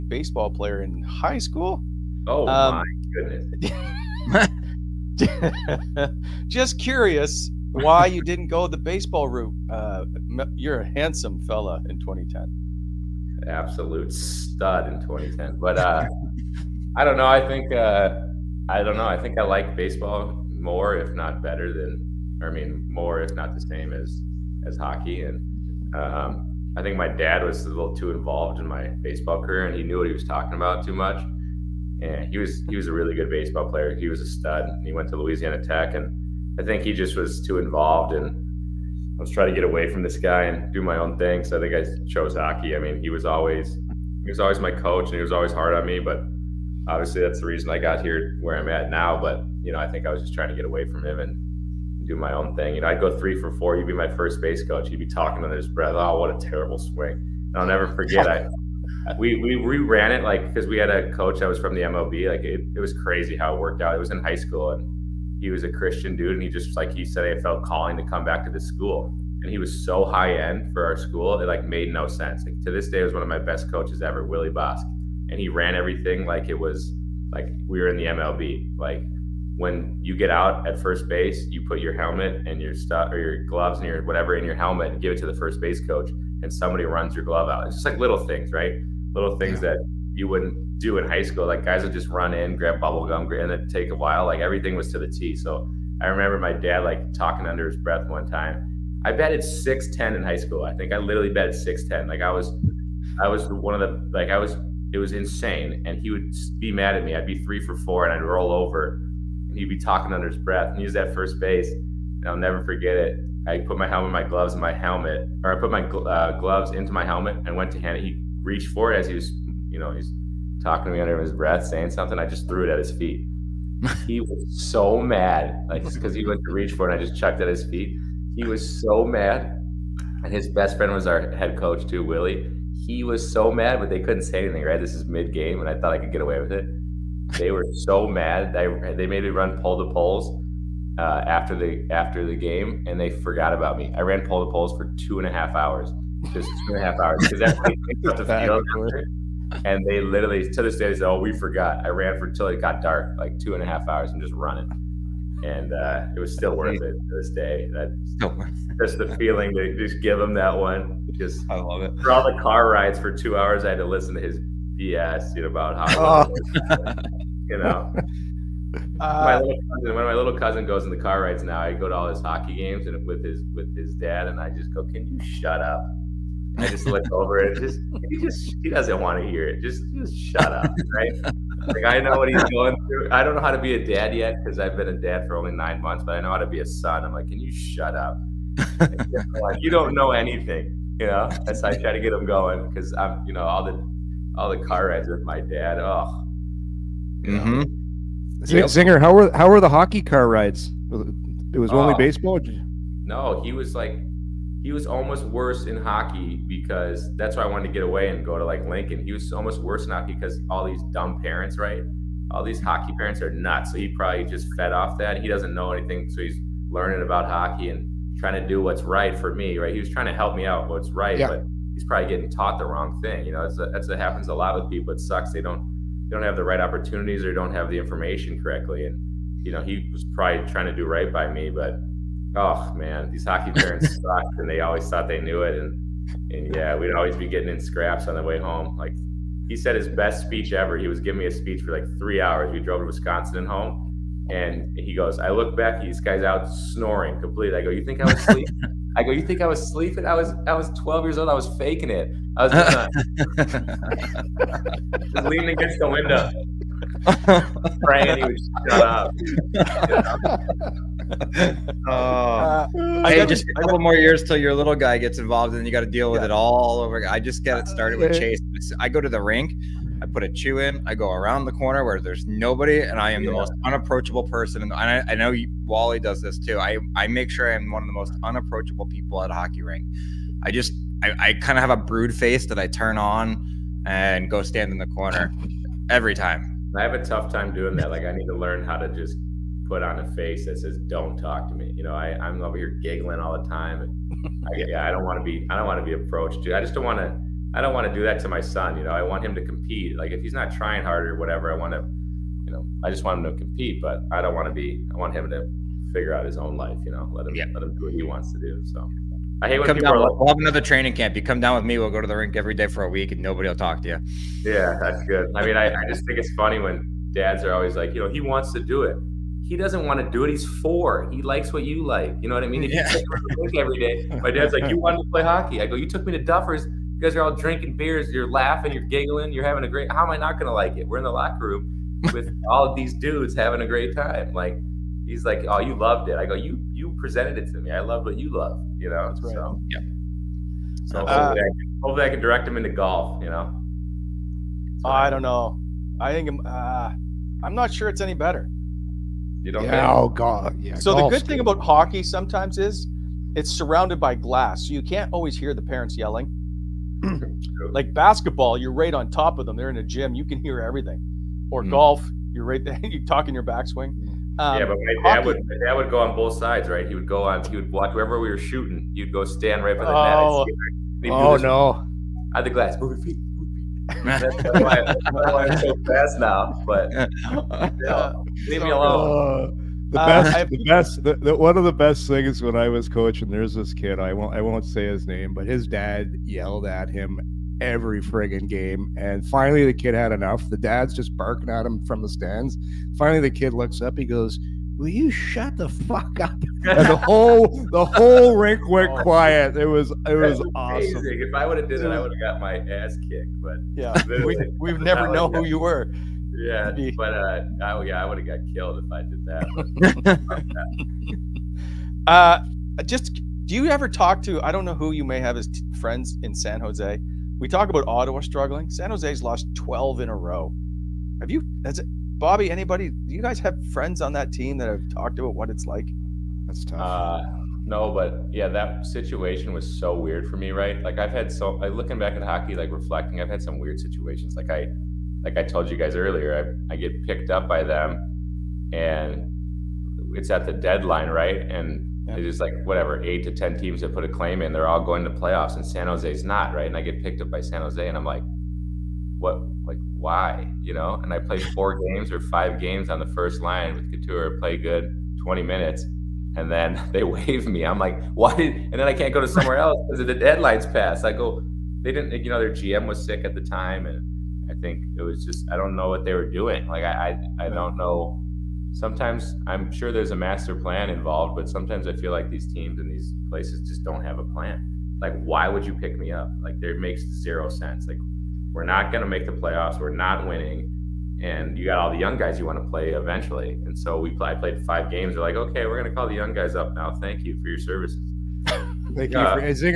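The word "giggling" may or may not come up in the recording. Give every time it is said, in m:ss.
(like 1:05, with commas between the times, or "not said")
4:52, 5:28.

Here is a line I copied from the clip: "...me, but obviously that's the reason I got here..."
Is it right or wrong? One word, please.
right.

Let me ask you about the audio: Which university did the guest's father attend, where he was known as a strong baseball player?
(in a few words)
Louisiana Tech.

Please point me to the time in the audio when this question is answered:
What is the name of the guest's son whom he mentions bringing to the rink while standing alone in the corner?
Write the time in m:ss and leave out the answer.
4:28.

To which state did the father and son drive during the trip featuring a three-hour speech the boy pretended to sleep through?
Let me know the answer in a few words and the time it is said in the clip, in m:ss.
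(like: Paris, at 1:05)
Wisconsin, at 4:02.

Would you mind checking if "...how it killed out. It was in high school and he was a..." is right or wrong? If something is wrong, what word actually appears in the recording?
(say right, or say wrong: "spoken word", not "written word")
wrong: "worked", not "killed".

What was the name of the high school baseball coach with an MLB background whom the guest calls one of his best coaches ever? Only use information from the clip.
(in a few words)
Willie Bosk.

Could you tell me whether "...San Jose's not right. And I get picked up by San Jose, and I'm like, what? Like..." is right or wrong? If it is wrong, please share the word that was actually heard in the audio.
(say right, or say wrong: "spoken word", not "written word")
right.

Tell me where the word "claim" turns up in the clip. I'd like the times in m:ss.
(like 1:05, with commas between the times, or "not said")
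7:24.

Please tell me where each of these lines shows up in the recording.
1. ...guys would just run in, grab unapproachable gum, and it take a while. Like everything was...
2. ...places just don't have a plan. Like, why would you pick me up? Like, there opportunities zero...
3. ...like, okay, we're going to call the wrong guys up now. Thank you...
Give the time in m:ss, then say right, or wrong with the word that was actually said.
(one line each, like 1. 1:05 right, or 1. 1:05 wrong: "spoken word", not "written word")
1. 1:31 wrong: "bubble", not "unapproachable"
2. 7:53 wrong: "makes", not "opportunities"
3. 8:05 wrong: "young", not "wrong".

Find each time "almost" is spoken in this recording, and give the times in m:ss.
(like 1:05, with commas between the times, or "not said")
3:24, 3:29.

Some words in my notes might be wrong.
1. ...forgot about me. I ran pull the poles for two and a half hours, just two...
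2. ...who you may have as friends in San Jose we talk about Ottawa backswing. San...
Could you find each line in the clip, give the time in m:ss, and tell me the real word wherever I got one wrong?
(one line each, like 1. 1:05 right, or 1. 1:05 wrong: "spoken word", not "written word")
1. 2:23 right
2. 6:54 wrong: "struggling", not "backswing".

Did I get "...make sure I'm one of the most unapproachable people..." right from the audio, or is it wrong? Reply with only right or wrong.
right.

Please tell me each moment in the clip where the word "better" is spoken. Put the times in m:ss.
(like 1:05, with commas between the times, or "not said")
0:21, 5:48.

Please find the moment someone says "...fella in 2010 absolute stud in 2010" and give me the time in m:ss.
0:11.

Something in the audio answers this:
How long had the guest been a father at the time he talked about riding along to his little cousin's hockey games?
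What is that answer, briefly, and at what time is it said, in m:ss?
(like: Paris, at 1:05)
9 months, at 3:05.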